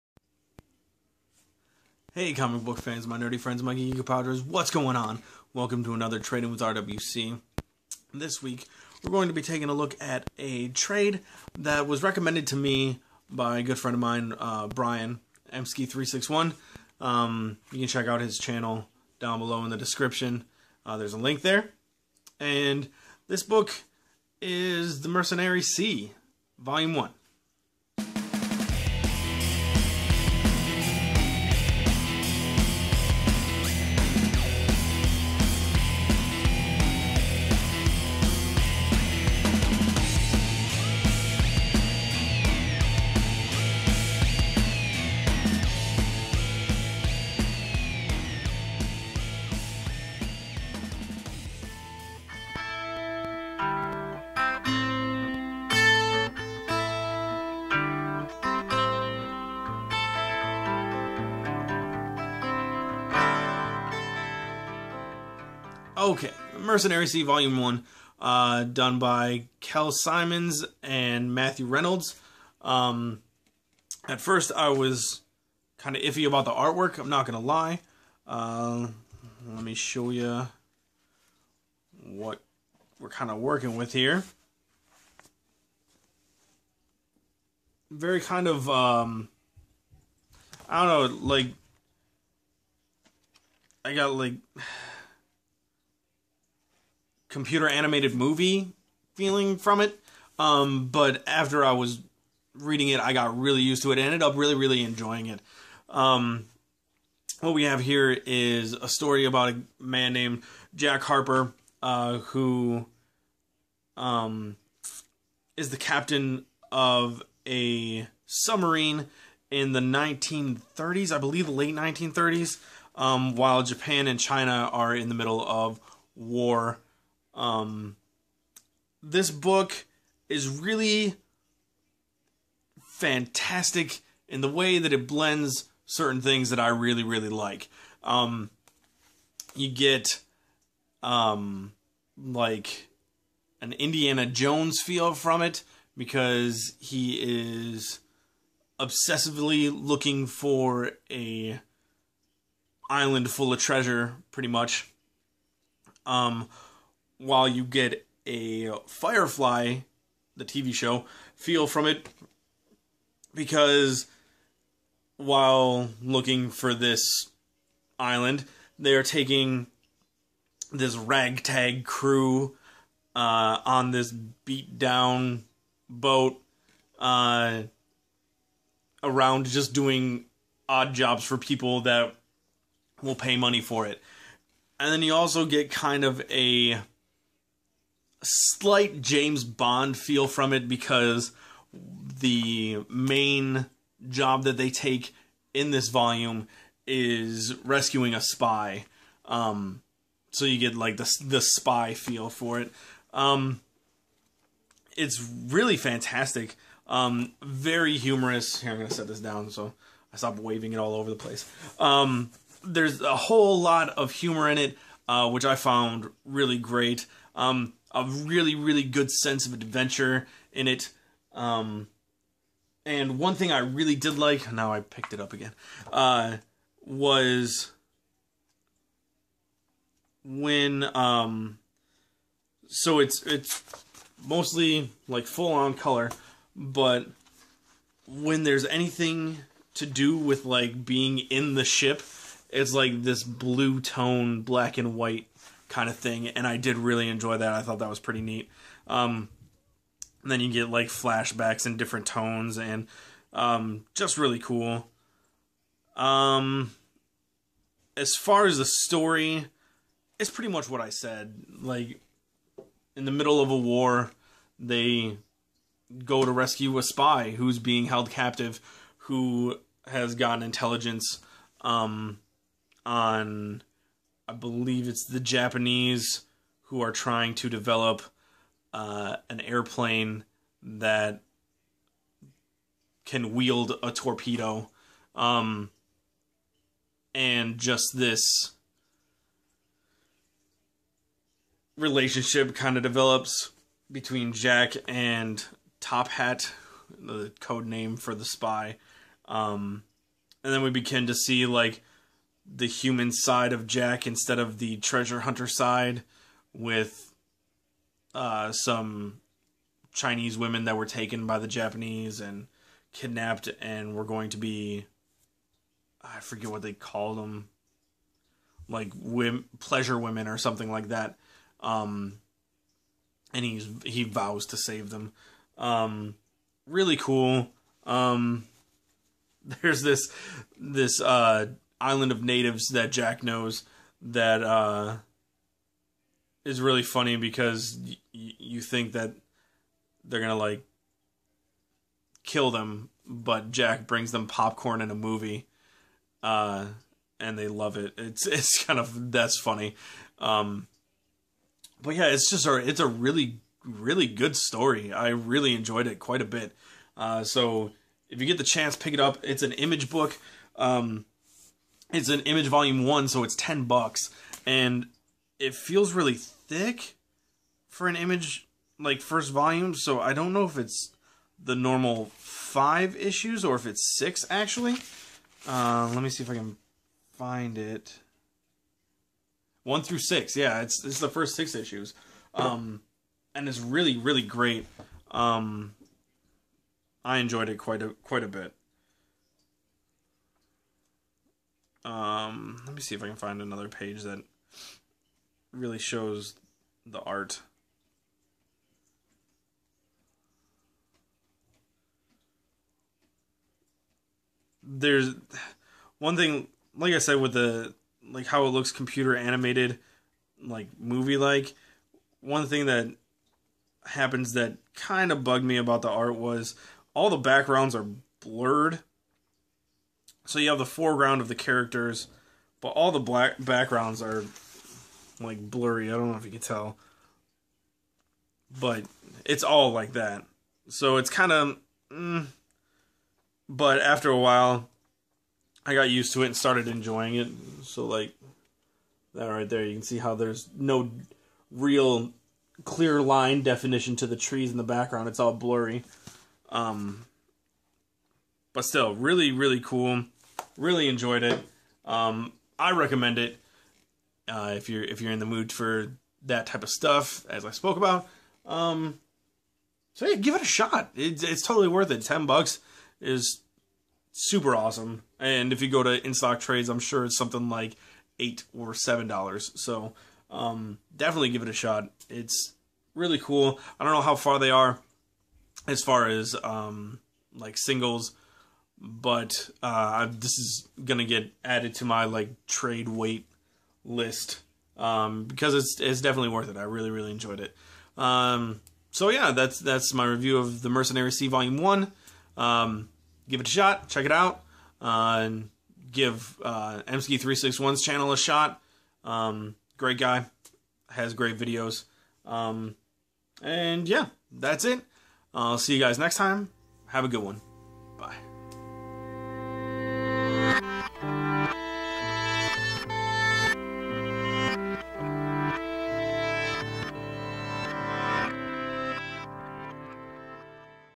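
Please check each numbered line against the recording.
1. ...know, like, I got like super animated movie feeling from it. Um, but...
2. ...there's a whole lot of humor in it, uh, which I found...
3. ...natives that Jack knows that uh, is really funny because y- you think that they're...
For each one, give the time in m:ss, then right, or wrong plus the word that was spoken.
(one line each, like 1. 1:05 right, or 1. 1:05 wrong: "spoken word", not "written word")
1. 1:31 wrong: "computer", not "super"
2. 3:32 right
3. 5:32 right.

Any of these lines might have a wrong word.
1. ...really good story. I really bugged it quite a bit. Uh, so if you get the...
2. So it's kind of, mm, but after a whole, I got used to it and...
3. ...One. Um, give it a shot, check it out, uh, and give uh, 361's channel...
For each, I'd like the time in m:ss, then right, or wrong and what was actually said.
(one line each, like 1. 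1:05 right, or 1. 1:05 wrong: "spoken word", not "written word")
1. 5:53 wrong: "enjoyed", not "bugged"
2. 7:10 wrong: "while", not "whole"
3. 8:11 right.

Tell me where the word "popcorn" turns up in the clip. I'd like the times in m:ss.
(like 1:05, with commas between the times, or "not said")
5:44.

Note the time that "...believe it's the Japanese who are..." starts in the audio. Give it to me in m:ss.
4:34.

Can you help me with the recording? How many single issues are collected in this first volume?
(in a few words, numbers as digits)
6.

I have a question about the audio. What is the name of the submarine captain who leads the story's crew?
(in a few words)
Jack Harper.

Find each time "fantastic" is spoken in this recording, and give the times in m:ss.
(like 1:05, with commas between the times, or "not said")
2:12, 3:25.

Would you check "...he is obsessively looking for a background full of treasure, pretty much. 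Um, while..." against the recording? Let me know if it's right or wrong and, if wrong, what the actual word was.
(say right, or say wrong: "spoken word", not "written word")
wrong: "island", not "background".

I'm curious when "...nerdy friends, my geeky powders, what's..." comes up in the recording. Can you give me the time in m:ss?
0:03.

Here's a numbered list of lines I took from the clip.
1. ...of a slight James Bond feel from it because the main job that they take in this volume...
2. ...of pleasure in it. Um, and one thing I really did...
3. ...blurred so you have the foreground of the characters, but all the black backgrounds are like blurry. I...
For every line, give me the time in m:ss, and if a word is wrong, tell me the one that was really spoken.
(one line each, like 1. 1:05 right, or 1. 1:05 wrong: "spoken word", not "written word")
1. 3:06 right
2. 3:39 wrong: "adventure", not "pleasure"
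3. 6:58 right.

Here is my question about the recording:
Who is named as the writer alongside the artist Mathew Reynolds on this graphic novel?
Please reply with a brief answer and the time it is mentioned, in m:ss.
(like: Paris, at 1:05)
Kel Symons, at 1:09.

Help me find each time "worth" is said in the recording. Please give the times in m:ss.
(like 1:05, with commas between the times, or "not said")
7:41, 8:06.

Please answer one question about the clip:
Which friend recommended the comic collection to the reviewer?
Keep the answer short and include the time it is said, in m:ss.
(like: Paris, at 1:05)
Brian Emsky361, at 0:14.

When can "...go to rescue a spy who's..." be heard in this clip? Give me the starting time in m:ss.
4:26.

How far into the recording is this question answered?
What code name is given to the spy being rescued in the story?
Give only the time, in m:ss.
4:55.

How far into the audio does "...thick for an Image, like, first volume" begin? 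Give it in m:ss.
6:06.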